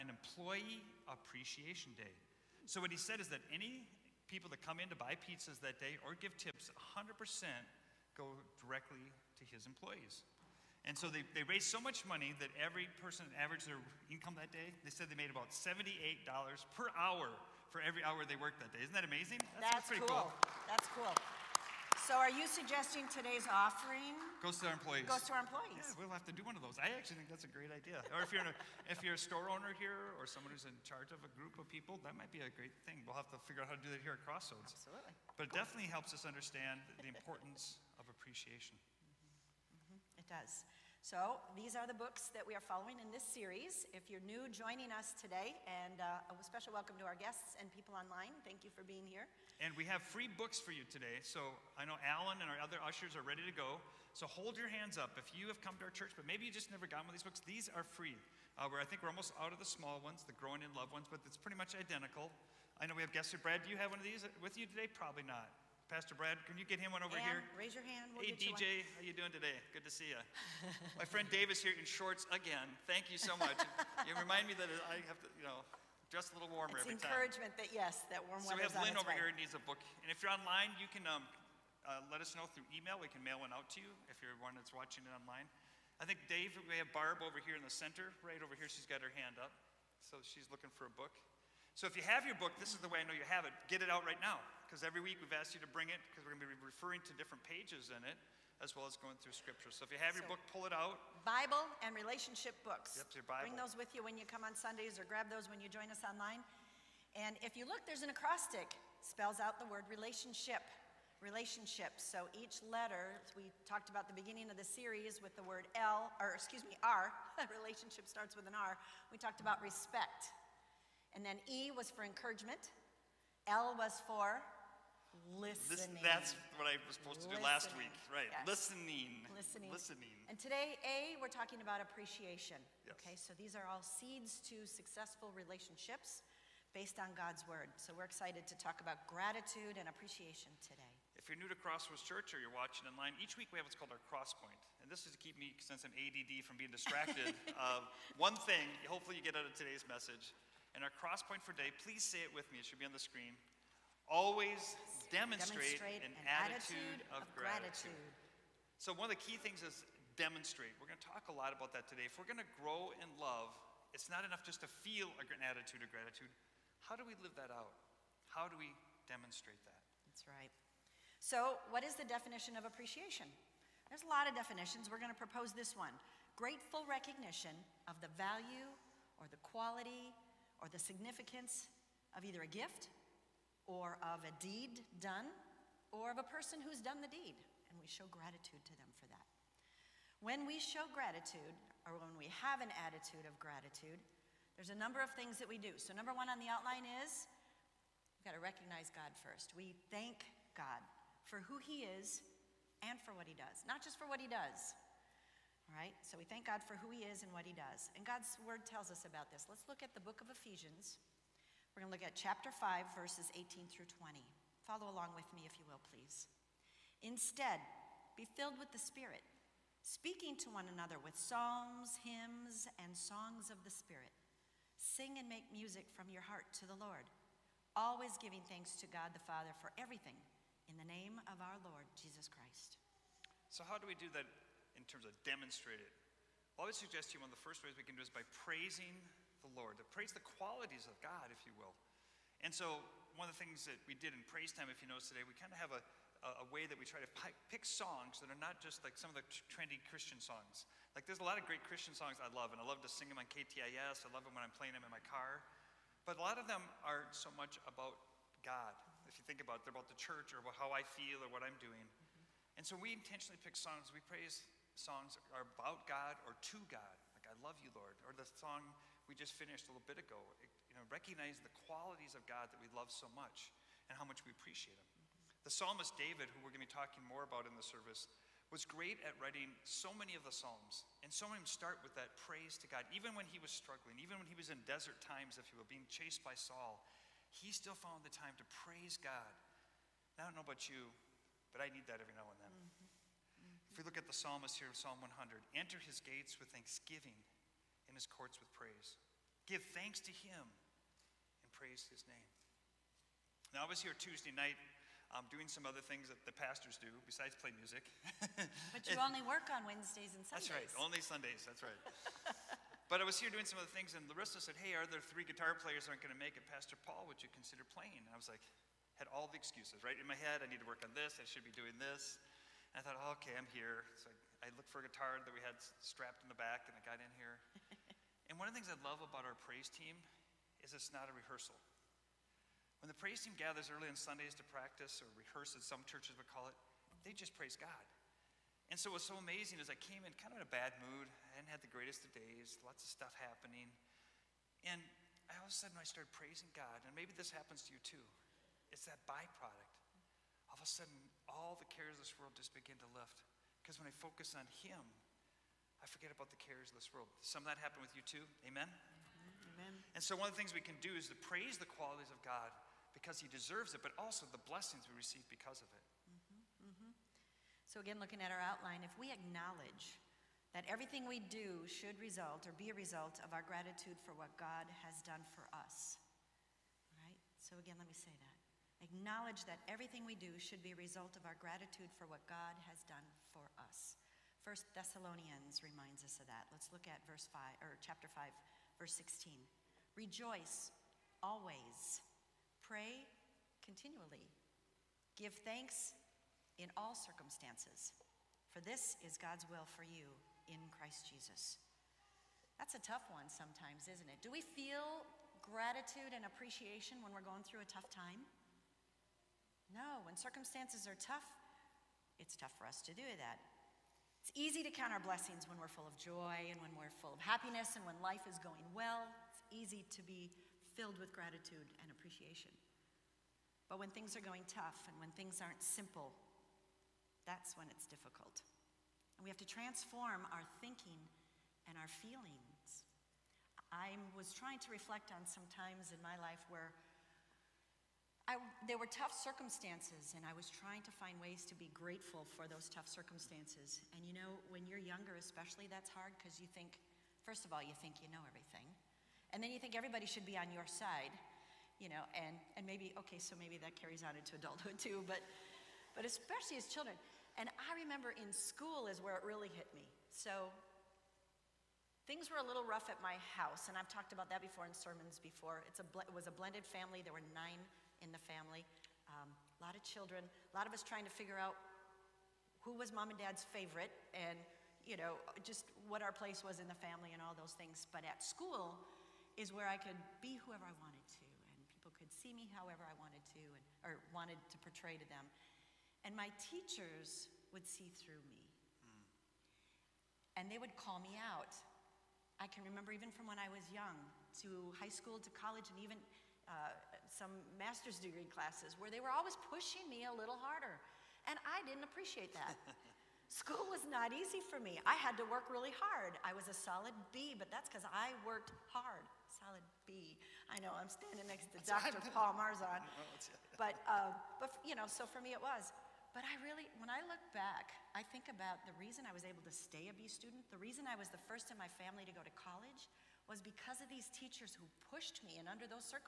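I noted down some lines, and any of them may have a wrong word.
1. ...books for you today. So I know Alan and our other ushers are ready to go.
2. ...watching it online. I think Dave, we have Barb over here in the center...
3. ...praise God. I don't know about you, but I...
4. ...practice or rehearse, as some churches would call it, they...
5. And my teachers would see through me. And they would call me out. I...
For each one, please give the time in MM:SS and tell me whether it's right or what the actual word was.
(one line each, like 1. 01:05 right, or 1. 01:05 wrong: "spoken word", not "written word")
1. 00:50 right
2. 01:24 right
3. 04:48 right
4. 05:34 right
5. 08:06 right.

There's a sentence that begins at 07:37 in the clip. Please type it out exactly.
And I remember in school is where it really hit me.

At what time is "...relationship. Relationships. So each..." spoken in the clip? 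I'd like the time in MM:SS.
01:49.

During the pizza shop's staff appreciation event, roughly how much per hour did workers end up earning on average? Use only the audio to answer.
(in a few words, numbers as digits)
$78.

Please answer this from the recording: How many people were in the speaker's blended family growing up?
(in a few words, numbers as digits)
9.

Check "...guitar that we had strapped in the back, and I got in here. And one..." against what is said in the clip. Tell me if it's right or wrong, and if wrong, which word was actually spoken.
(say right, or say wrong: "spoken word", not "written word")
right.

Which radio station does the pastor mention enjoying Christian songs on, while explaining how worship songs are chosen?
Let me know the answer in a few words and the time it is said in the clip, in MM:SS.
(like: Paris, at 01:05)
KTIS, at 04:13.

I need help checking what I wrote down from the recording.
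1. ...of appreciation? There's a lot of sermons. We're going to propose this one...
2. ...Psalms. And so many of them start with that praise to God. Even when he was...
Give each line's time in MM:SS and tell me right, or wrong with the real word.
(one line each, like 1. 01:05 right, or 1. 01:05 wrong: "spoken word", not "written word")
1. 02:52 wrong: "definitions", not "sermons"
2. 04:40 right.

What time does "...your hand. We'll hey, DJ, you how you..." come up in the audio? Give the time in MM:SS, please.
01:07.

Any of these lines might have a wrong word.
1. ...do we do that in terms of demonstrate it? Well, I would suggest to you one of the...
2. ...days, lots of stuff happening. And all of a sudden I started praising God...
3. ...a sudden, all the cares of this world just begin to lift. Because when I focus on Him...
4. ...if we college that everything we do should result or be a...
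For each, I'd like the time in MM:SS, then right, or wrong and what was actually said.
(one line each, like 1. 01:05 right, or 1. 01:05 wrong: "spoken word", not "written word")
1. 03:53 right
2. 05:42 right
3. 05:50 right
4. 06:08 wrong: "acknowledge", not "college".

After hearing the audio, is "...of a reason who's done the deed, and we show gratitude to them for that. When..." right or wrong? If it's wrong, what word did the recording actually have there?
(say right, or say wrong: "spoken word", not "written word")
wrong: "person", not "reason".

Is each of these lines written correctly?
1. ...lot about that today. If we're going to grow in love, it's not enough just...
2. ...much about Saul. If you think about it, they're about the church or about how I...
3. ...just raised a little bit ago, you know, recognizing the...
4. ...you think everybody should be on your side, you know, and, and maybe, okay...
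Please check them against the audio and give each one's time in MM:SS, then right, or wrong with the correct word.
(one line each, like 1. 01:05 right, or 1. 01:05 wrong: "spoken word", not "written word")
1. 02:41 right
2. 04:17 wrong: "God", not "Saul"
3. 04:29 wrong: "finished", not "raised"
4. 07:29 right.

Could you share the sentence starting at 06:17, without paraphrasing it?
So, again, let me say that.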